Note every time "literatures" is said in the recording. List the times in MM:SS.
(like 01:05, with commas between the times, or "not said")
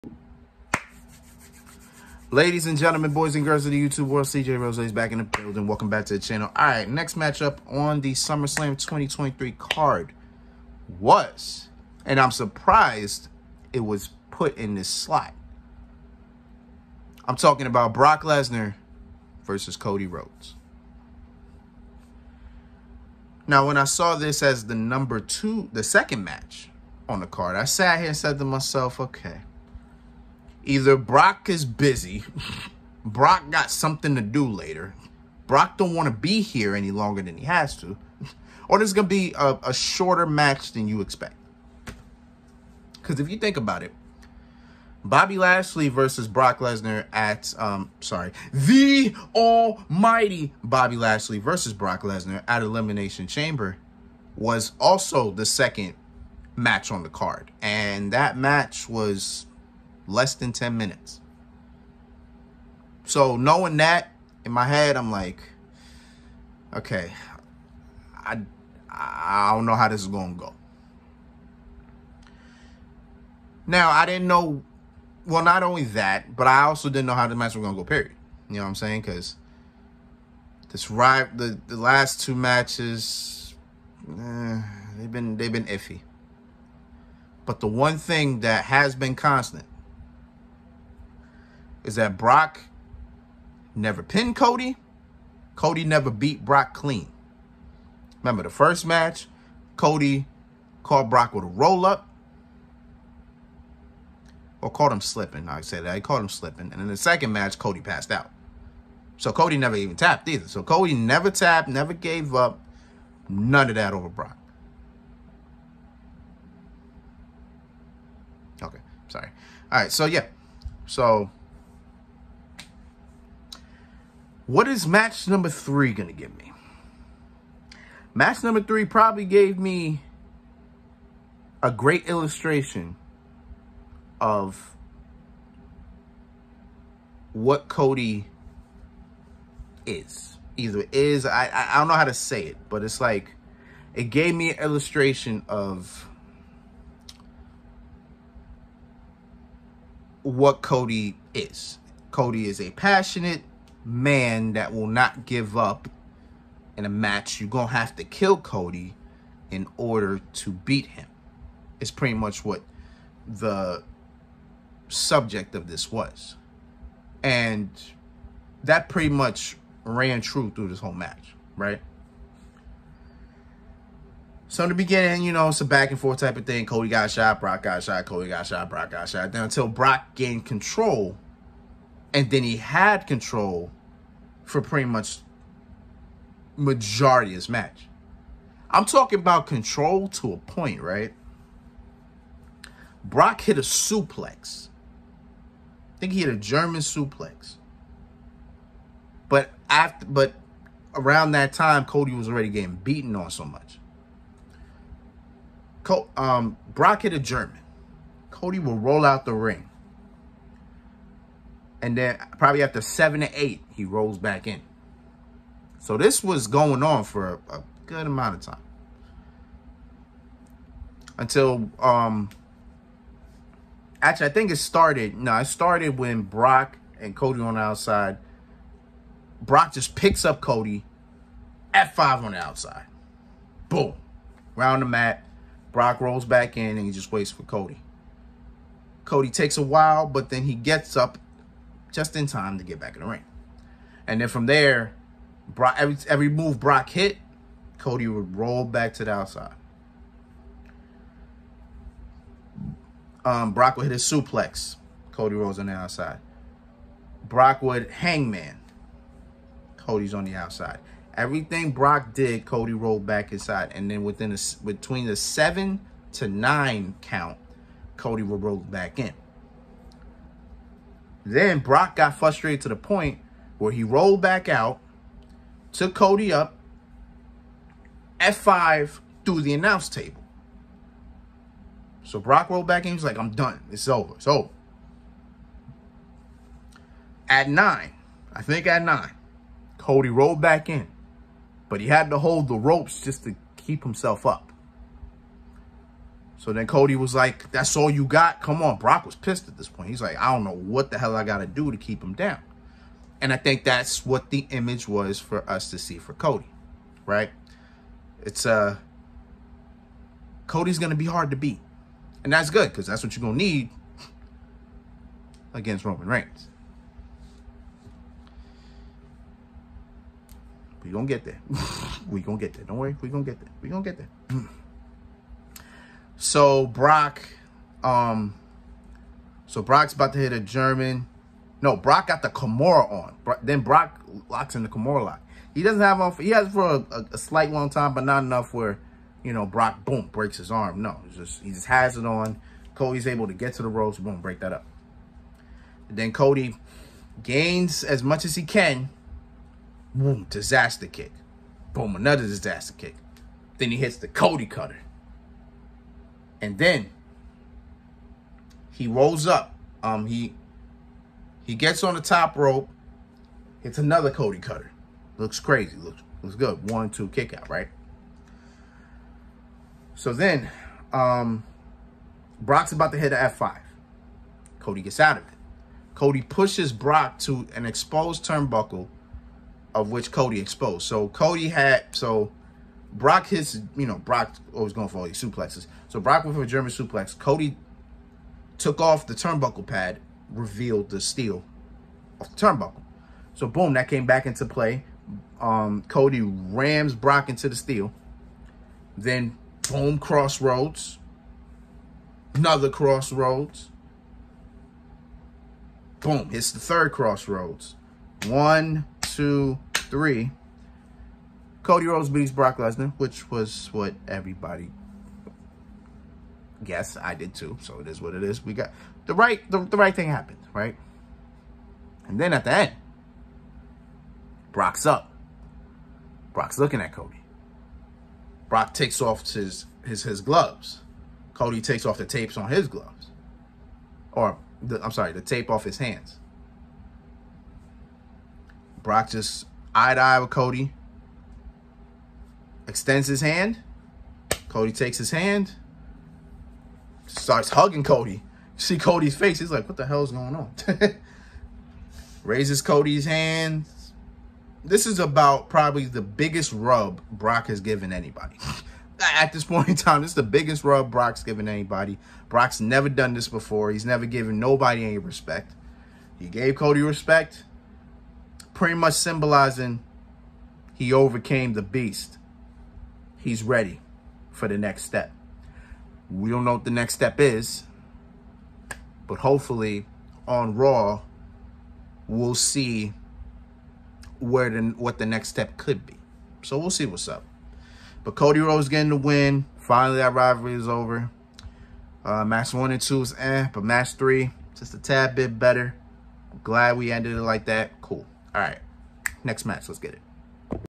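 not said.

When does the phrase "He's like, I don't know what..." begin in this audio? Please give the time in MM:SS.
04:59.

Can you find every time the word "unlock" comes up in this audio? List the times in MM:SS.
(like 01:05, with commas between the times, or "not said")
not said.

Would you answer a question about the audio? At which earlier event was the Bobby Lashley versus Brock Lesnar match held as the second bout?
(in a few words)
Elimination Chamber.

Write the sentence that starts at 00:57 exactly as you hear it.
And that match was less than 10 minutes.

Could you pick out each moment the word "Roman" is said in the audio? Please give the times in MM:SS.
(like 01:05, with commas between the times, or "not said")
05:15.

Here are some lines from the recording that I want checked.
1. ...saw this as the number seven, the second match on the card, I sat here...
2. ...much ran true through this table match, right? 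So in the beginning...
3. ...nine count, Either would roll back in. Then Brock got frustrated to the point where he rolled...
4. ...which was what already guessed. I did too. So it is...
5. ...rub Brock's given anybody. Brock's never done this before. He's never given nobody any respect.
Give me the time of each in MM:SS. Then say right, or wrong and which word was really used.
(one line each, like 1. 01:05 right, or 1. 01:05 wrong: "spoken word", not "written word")
1. 00:23 wrong: "two", not "seven"
2. 02:49 wrong: "whole", not "table"
3. 04:26 wrong: "Cody", not "Either"
4. 06:52 wrong: "everybody", not "already"
5. 07:40 right.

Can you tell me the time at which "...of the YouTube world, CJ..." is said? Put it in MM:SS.
00:03.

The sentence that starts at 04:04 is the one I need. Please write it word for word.
And then from there, Brock, every, every move Brock hit, Cody would roll back to the outside.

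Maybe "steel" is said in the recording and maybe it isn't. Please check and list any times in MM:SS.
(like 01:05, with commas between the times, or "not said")
06:30, 06:37.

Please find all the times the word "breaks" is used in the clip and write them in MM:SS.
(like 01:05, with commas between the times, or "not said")
05:40, 05:44.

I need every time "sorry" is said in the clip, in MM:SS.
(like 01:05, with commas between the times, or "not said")
00:48, 01:59, 07:14.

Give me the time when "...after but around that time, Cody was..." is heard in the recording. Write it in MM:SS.
03:19.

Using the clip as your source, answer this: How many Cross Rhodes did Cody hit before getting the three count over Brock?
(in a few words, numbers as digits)
3.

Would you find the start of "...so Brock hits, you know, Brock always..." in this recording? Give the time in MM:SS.
06:21.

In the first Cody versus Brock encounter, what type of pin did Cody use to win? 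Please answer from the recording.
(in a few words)
roll up.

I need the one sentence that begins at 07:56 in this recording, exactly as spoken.
We don't know what the next step is, but hopefully on Raw, we'll see where the, what the next step could be.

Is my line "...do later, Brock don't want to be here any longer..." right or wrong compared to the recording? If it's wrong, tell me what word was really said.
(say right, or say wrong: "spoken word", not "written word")
right.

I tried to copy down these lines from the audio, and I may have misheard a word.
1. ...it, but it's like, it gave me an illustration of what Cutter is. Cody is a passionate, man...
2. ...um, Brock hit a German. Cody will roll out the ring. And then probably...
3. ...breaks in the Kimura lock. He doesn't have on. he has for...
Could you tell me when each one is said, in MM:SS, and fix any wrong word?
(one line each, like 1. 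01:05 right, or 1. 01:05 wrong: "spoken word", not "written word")
1. 02:22 wrong: "Cody", not "Cutter"
2. 03:26 right
3. 05:34 wrong: "locks", not "breaks".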